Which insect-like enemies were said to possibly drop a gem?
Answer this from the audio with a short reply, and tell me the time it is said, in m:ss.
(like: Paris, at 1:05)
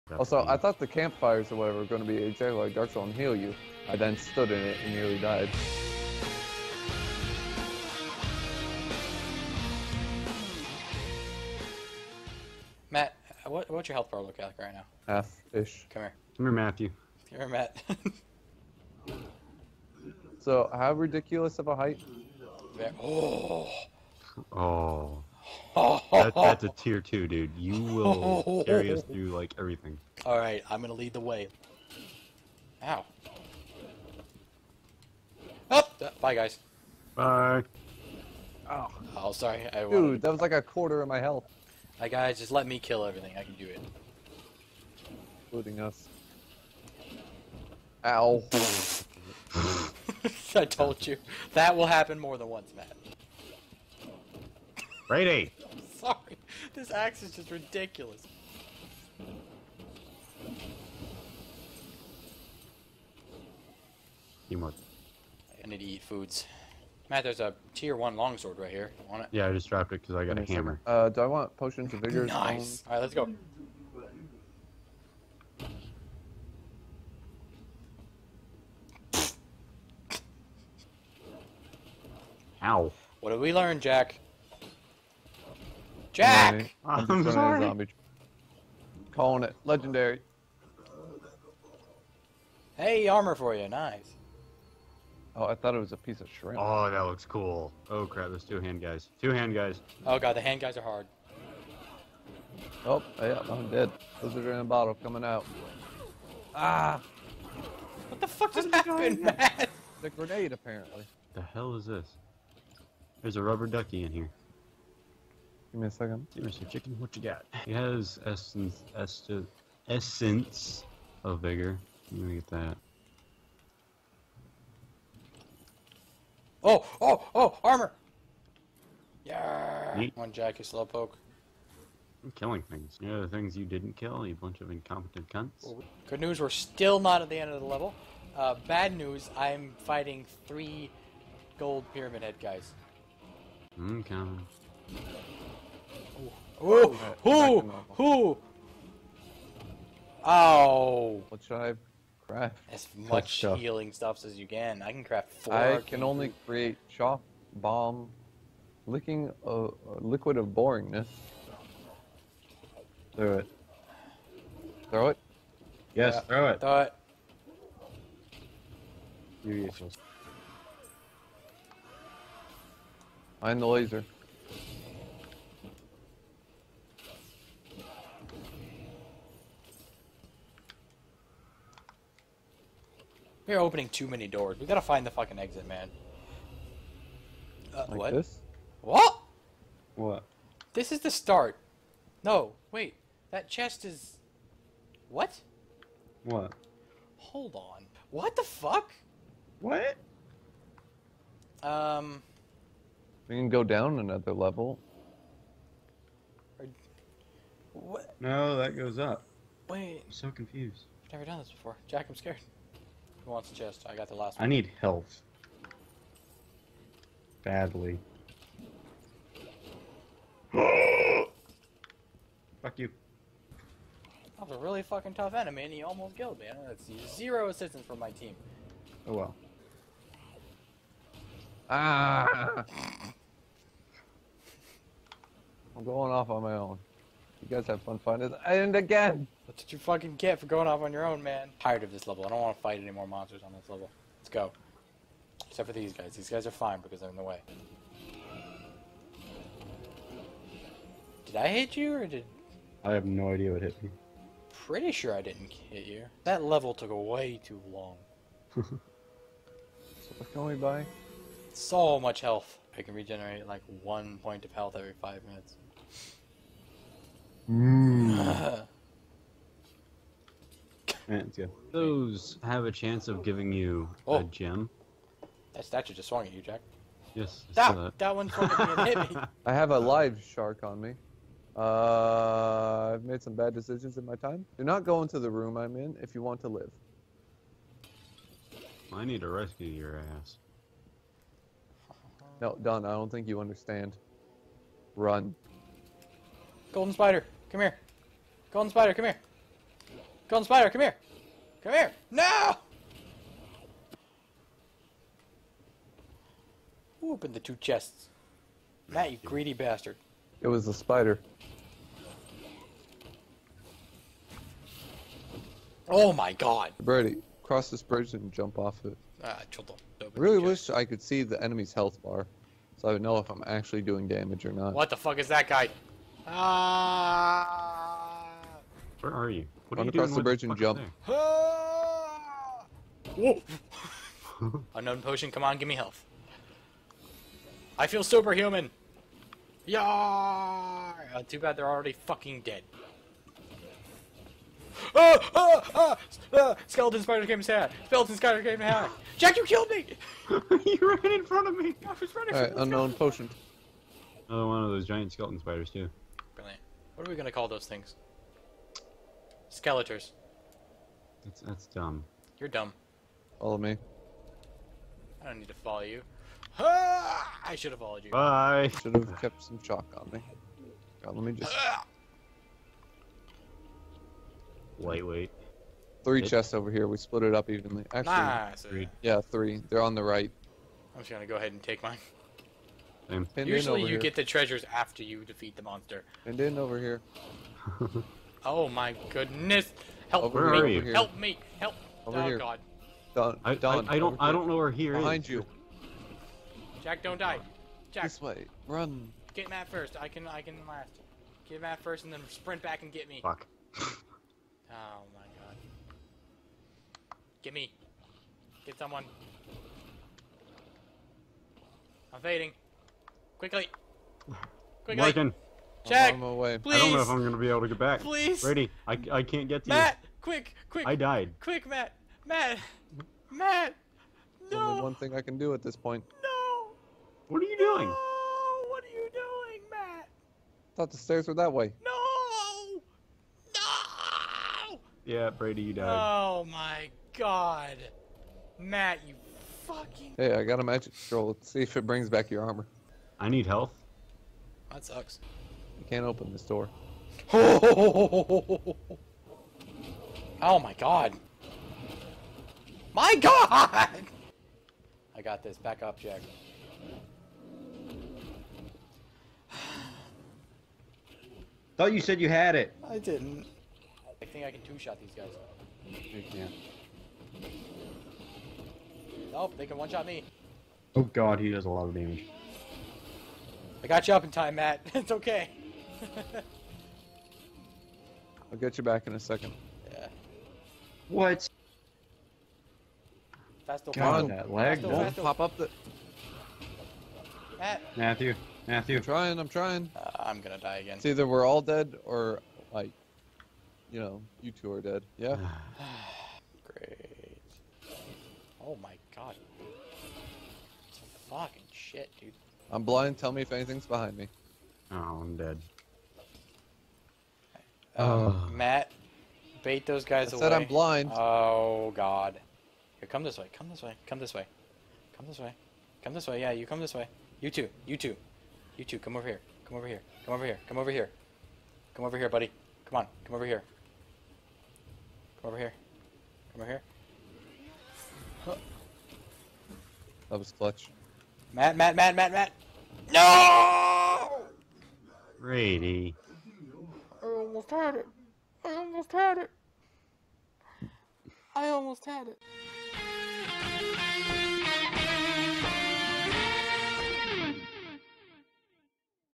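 Ants, at 4:31.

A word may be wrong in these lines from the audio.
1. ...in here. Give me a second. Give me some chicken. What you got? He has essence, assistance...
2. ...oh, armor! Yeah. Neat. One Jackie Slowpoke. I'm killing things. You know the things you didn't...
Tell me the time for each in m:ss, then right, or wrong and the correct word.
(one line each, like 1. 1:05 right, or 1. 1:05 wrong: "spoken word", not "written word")
1. 1:54 wrong: "essence", not "assistance"
2. 2:07 right.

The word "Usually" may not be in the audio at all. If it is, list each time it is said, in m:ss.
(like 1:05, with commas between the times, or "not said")
6:23.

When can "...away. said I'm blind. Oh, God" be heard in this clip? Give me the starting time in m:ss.
8:30.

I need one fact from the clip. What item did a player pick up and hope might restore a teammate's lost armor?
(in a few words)
magic scroll.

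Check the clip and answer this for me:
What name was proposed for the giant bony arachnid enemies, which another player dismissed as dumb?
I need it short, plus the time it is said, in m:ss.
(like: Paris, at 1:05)
Skeletors, at 5:59.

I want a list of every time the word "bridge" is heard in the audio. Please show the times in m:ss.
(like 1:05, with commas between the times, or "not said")
5:17, 5:30.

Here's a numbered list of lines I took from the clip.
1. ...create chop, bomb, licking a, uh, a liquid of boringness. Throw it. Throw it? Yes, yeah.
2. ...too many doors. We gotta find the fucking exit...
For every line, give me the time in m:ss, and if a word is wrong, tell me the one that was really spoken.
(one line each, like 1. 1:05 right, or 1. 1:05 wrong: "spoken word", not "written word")
1. 2:36 right
2. 3:03 right.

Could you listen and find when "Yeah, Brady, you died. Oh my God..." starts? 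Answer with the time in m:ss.
7:15.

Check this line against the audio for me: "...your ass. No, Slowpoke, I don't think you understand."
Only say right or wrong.
wrong.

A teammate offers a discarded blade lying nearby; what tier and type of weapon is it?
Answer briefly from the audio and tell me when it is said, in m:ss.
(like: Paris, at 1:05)
tier one longsword, at 1:07.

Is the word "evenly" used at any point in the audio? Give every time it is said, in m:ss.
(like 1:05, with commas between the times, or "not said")
6:17.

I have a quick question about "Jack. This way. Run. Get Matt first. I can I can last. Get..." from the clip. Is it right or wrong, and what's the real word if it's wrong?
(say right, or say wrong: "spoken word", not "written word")
right.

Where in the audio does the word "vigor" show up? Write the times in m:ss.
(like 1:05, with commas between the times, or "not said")
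1:11, 2:01.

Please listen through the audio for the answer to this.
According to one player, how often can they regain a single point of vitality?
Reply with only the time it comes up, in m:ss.
4:24.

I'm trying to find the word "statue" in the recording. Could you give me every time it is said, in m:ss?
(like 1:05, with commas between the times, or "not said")
4:35.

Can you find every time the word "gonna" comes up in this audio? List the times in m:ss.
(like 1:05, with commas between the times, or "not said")
0:30, 5:57, 6:21, 6:57, 8:10.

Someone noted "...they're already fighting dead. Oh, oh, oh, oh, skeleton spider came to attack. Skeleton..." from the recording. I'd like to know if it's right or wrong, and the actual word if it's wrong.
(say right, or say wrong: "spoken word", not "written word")
wrong: "fucking", not "fighting".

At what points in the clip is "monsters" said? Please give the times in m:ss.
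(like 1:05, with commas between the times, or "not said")
4:03, 6:25.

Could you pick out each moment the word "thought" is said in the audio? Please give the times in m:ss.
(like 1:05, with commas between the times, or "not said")
0:00, 1:35, 7:10, 7:41.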